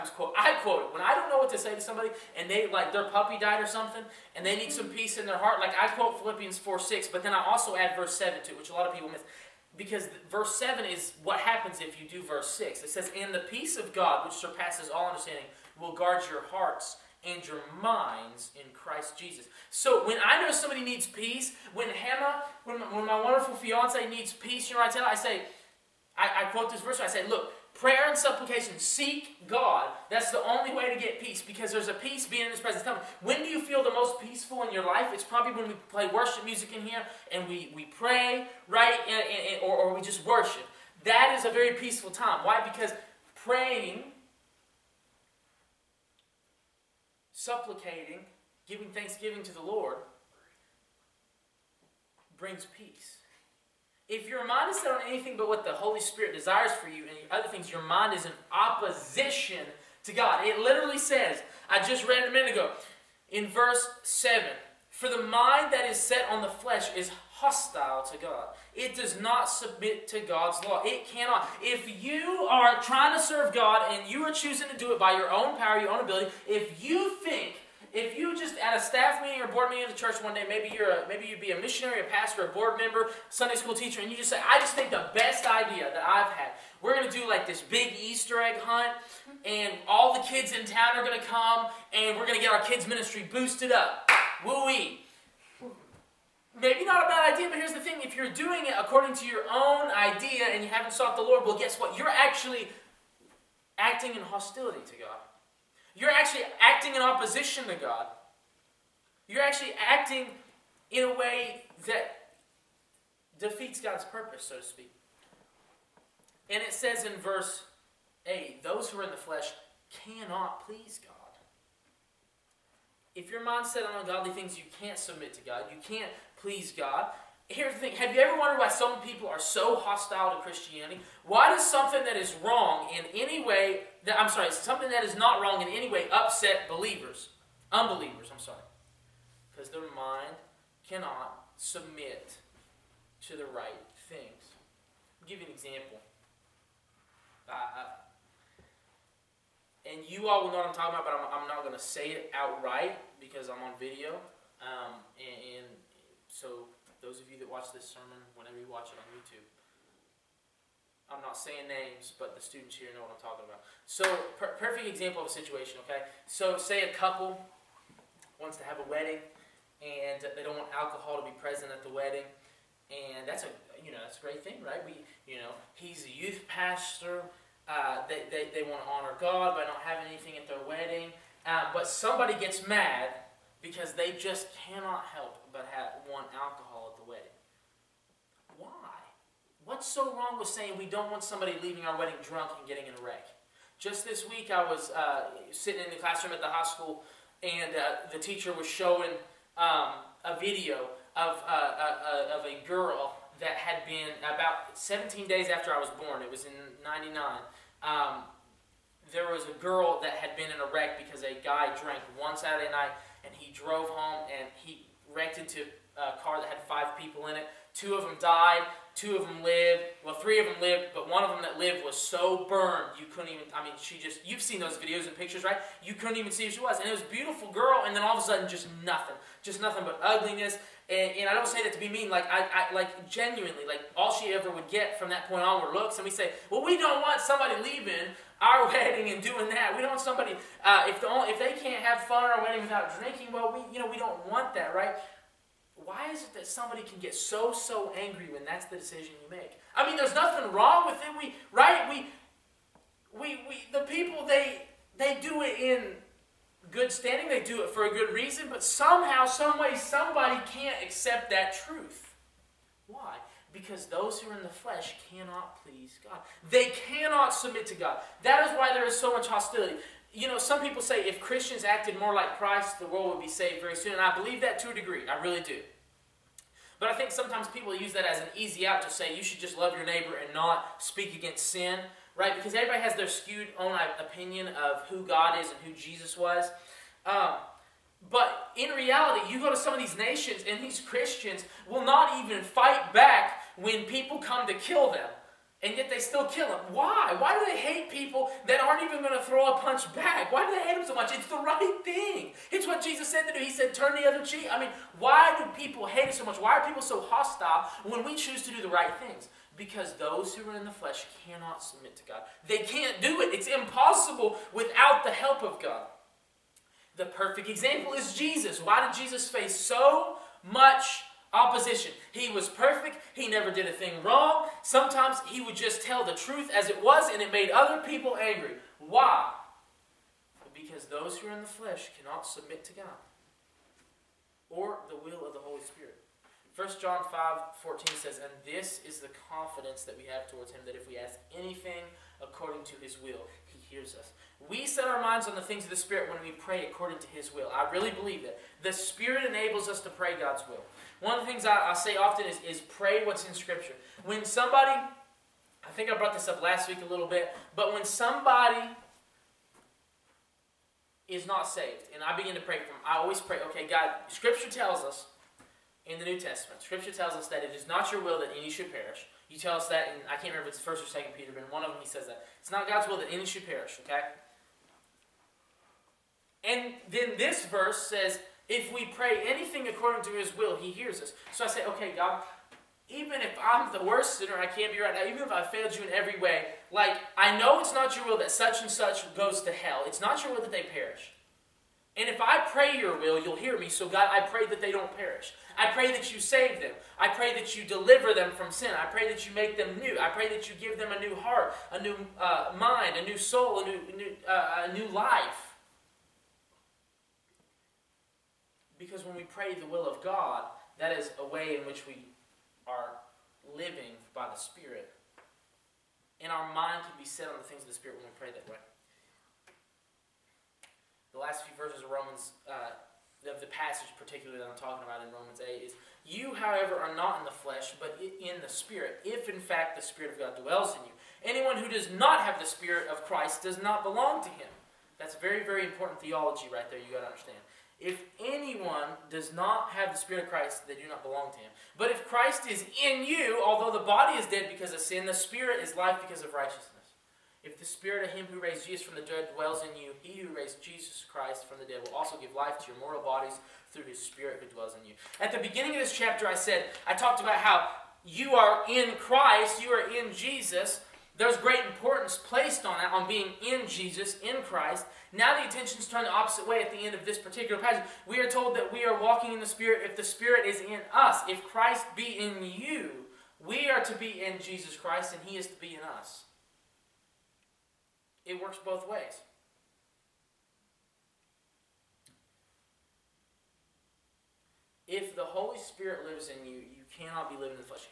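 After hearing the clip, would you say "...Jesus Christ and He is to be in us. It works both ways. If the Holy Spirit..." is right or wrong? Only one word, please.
right.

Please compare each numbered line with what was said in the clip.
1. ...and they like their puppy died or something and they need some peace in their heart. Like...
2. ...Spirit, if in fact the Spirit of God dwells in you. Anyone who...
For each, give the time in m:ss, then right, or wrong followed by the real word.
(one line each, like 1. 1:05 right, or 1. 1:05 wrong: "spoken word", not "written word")
1. 0:02 right
2. 7:08 right.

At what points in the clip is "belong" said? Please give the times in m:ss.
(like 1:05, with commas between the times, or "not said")
7:13, 7:21.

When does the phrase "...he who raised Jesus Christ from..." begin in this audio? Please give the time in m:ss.
7:30.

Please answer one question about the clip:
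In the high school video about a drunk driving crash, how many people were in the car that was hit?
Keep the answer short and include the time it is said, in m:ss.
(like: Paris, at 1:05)
5, at 3:36.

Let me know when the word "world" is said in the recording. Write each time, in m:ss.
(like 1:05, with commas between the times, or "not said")
4:32.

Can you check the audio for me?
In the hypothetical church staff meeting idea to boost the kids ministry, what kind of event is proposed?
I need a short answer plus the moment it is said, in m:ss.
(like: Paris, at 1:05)
Easter egg hunt, at 1:28.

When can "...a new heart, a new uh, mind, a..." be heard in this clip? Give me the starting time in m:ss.
6:40.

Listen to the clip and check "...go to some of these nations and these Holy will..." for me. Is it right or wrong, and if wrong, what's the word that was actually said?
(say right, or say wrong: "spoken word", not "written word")
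wrong: "Christians", not "Holy".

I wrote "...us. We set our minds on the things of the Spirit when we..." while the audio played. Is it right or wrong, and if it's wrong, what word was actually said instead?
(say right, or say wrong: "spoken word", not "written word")
right.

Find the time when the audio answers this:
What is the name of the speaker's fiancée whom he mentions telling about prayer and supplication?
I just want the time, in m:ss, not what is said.
0:21.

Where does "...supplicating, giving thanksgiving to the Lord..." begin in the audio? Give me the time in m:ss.
0:47.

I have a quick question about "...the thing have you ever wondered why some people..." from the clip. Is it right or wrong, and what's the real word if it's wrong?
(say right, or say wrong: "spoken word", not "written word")
right.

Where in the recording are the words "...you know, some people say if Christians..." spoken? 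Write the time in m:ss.
4:30.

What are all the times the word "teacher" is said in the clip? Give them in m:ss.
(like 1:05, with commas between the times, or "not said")
1:23, 3:18.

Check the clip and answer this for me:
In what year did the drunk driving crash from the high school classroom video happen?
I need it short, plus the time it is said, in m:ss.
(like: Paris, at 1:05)
1999, at 3:26.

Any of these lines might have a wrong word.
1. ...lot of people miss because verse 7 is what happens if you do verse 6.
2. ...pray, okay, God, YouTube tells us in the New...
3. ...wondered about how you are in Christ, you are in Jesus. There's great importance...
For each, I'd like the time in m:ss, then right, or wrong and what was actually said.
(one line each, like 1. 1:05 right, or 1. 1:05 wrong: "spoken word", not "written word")
1. 0:08 right
2. 6:03 wrong: "Scripture", not "YouTube"
3. 7:36 wrong: "talked", not "wondered".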